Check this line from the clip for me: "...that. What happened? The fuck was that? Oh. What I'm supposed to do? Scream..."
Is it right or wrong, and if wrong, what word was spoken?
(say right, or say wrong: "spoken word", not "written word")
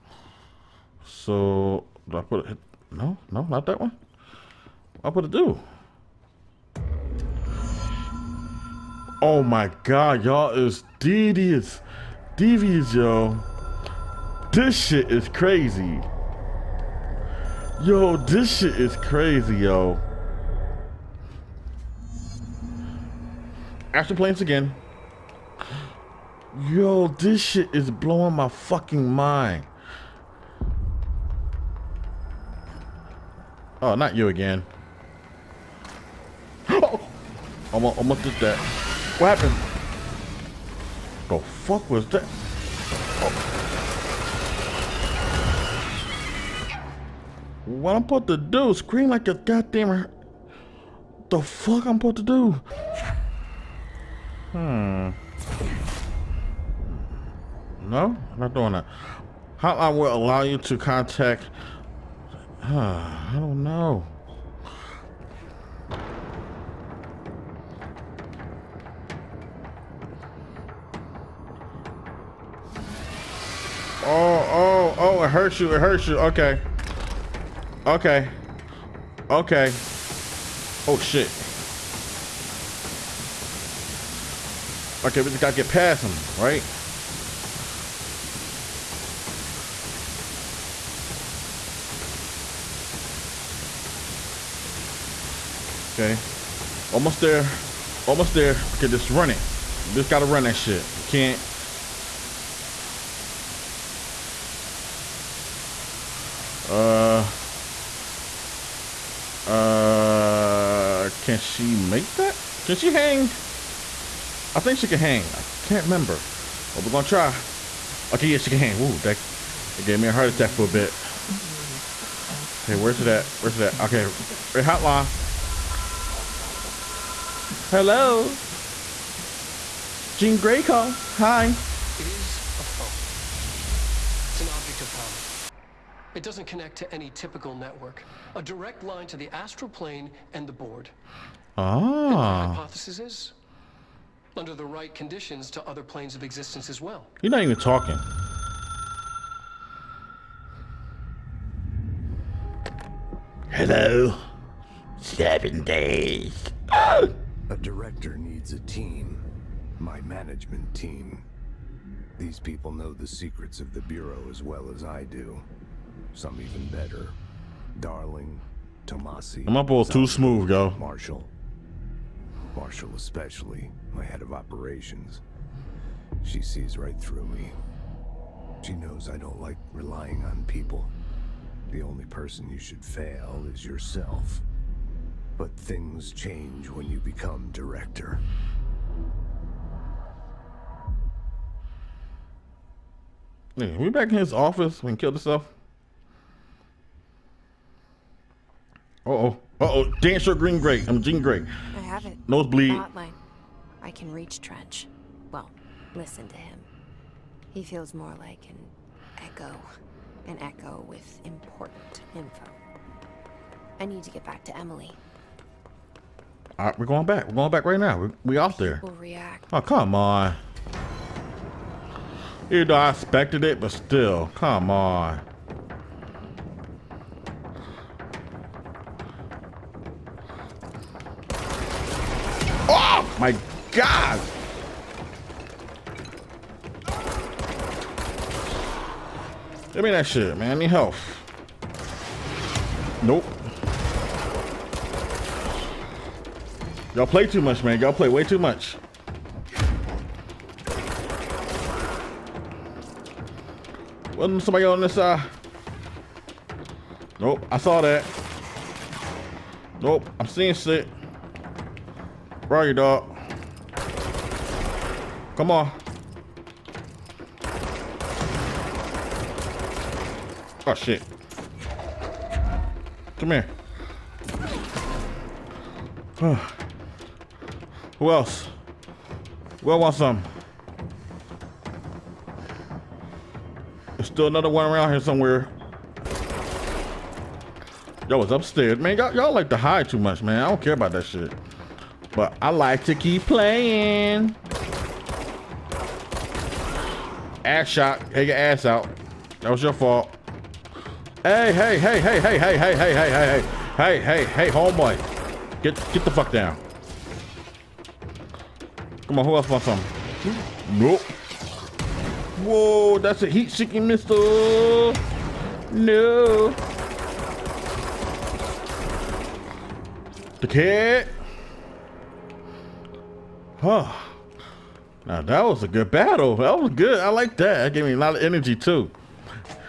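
right.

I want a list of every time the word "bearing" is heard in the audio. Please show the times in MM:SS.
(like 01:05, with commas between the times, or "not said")
not said.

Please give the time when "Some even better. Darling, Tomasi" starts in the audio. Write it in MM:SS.
02:46.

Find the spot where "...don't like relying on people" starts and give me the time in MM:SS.
02:59.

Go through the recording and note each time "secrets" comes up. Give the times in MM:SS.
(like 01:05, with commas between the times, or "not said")
02:43.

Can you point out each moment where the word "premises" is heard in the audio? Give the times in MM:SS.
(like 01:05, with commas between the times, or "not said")
not said.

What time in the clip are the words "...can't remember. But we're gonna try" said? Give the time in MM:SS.
01:55.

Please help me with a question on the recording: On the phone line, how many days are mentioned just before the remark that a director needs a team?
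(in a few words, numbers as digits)
7.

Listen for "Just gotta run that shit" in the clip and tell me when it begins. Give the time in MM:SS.
01:39.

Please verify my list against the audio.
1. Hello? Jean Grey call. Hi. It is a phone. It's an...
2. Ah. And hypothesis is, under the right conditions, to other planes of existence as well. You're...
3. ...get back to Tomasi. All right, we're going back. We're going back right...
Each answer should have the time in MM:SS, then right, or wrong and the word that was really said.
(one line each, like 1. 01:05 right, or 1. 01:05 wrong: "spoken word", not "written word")
1. 02:07 right
2. 02:21 right
3. 03:34 wrong: "Emily", not "Tomasi".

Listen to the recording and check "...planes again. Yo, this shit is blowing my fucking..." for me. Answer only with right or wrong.
right.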